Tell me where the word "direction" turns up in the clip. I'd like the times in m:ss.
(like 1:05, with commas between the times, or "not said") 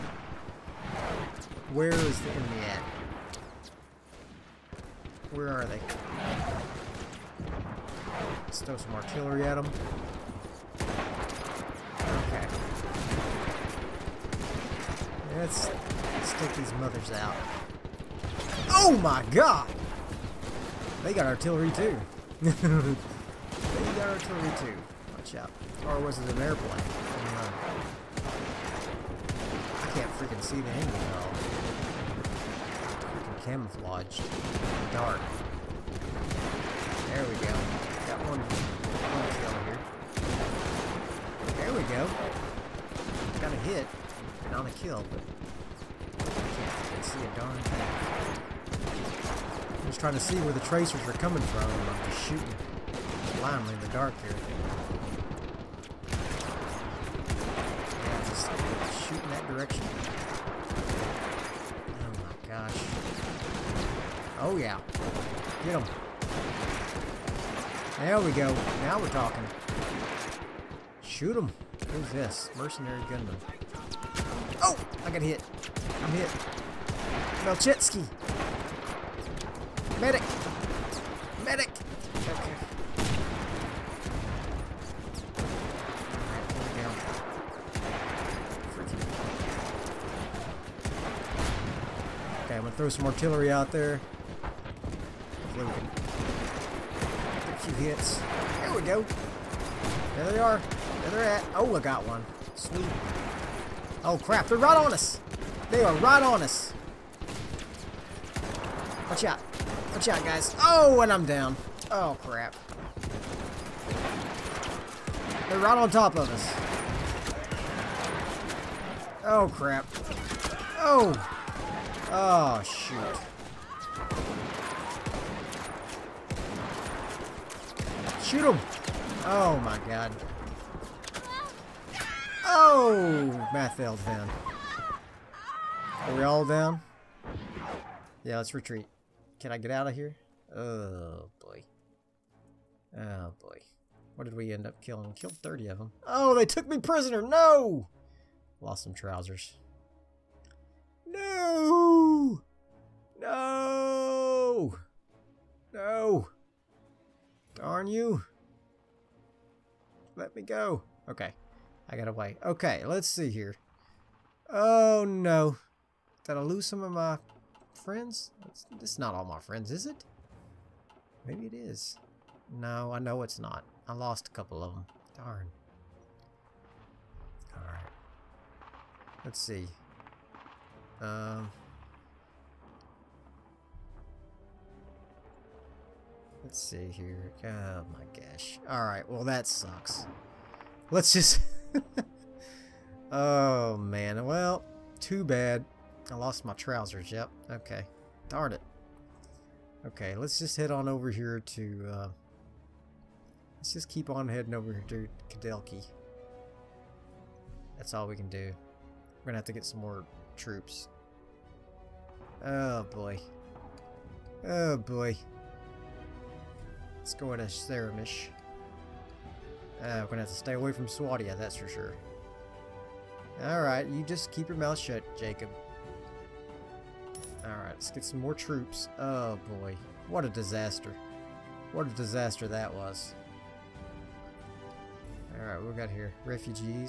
0:59.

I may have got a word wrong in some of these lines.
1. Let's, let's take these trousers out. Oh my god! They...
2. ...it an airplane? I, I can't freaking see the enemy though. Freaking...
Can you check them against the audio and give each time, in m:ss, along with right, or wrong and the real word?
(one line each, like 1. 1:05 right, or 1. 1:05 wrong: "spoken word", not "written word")
1. 0:15 wrong: "mothers", not "trousers"
2. 0:26 right.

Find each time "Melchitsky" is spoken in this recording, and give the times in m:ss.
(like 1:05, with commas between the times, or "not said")
1:17.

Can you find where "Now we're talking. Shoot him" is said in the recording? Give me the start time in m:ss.
1:08.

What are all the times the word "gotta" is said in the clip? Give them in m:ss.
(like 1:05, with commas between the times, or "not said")
2:41.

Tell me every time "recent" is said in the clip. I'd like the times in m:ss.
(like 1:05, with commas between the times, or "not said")
not said.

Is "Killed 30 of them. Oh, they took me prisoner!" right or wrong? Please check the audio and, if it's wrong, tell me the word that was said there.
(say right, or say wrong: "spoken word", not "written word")
right.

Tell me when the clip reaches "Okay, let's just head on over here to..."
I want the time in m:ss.
3:19.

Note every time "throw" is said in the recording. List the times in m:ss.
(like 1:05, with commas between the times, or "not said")
0:08, 1:32.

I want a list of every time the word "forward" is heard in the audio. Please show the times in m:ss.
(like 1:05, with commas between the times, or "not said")
not said.